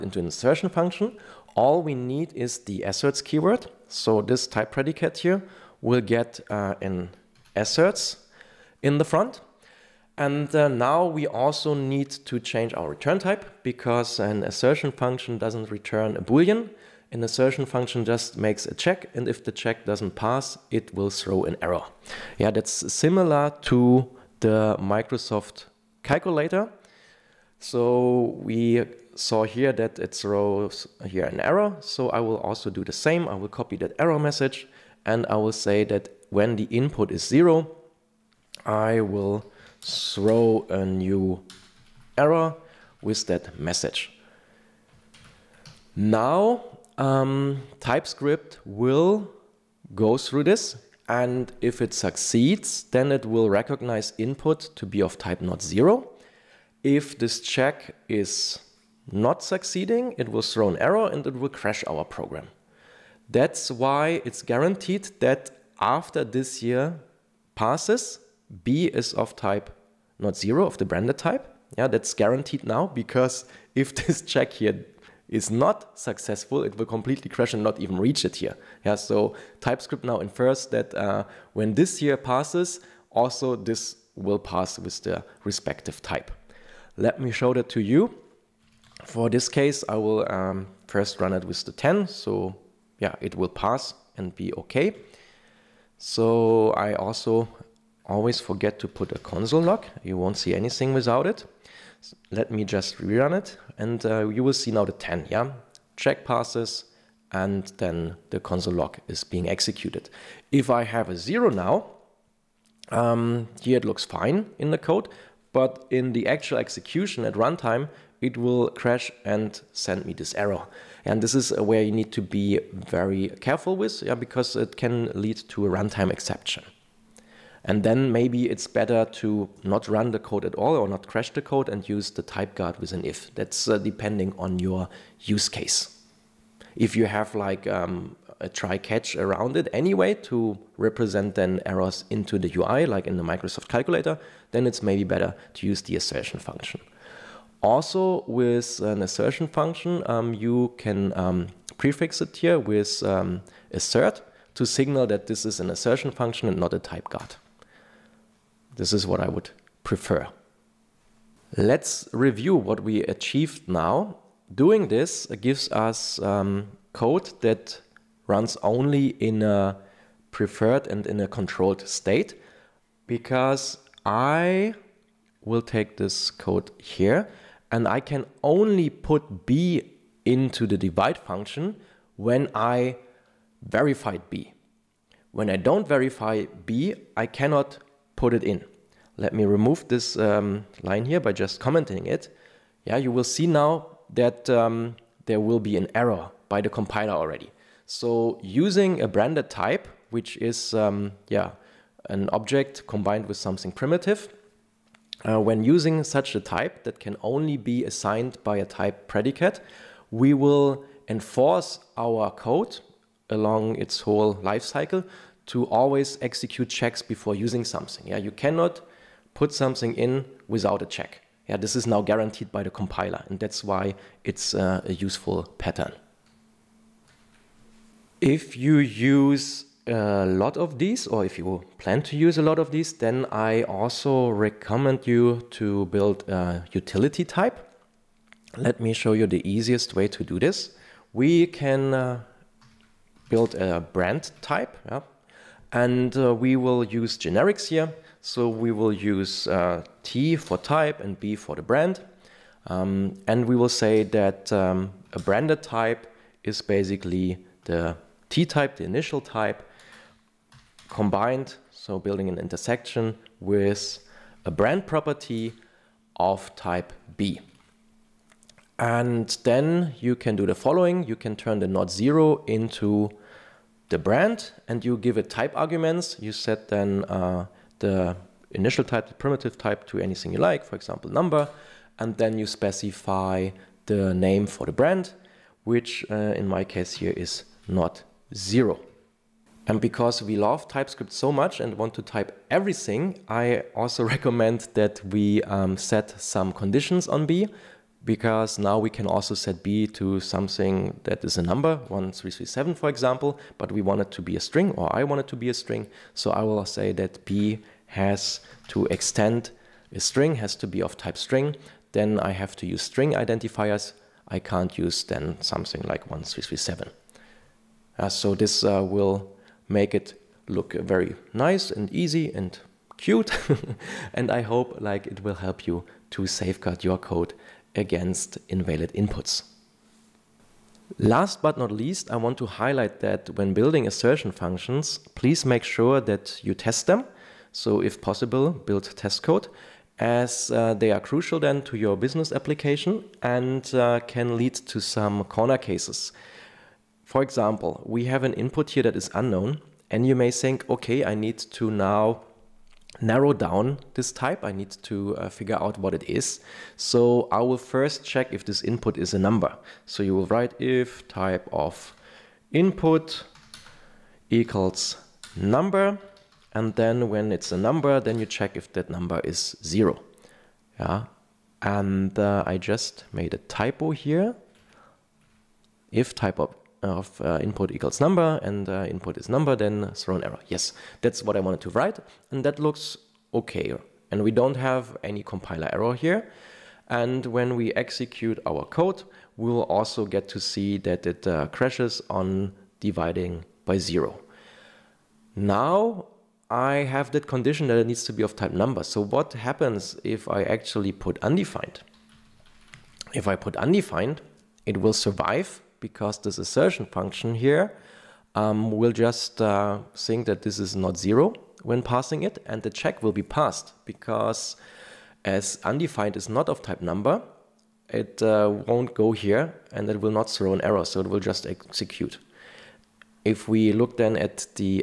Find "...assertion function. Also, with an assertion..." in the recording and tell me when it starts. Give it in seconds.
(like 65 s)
145 s.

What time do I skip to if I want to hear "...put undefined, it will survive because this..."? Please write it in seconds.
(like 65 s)
403 s.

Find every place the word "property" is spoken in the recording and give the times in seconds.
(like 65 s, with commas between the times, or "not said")
264 s.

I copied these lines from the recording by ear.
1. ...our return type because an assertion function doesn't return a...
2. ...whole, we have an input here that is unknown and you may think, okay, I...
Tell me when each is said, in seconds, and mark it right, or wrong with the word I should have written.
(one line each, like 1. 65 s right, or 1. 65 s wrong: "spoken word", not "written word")
1. 12 s right
2. 347 s wrong: "example", not "whole".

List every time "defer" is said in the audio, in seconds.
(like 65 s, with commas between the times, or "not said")
not said.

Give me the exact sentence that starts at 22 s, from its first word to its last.
Yeah, that's similar to the Microsoft calculator so we saw here that it throws here an error.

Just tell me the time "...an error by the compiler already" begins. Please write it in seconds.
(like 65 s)
195 s.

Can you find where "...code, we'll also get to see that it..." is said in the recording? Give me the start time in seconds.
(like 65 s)
388 s.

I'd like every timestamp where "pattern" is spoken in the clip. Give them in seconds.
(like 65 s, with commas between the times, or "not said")
225 s.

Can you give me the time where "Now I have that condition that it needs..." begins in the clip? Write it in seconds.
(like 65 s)
395 s.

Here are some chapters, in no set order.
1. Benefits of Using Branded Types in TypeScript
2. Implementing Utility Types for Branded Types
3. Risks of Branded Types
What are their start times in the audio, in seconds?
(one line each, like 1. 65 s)
1. 161 s
2. 227 s
3. 330 s.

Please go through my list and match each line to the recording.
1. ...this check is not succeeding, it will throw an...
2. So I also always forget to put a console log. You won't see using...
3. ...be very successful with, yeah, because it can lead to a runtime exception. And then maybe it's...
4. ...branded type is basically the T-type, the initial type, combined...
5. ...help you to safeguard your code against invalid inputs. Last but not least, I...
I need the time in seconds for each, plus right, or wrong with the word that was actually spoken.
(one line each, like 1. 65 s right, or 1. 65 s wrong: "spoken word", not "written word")
1. 57 s right
2. 95 s wrong: "anything", not "using"
3. 122 s wrong: "careful", not "successful"
4. 255 s right
5. 325 s right.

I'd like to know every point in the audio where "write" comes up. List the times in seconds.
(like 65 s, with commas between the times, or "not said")
360 s, 381 s.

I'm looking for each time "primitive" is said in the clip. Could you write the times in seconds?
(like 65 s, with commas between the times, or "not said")
203 s, 279 s.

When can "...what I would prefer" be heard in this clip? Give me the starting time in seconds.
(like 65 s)
159 s.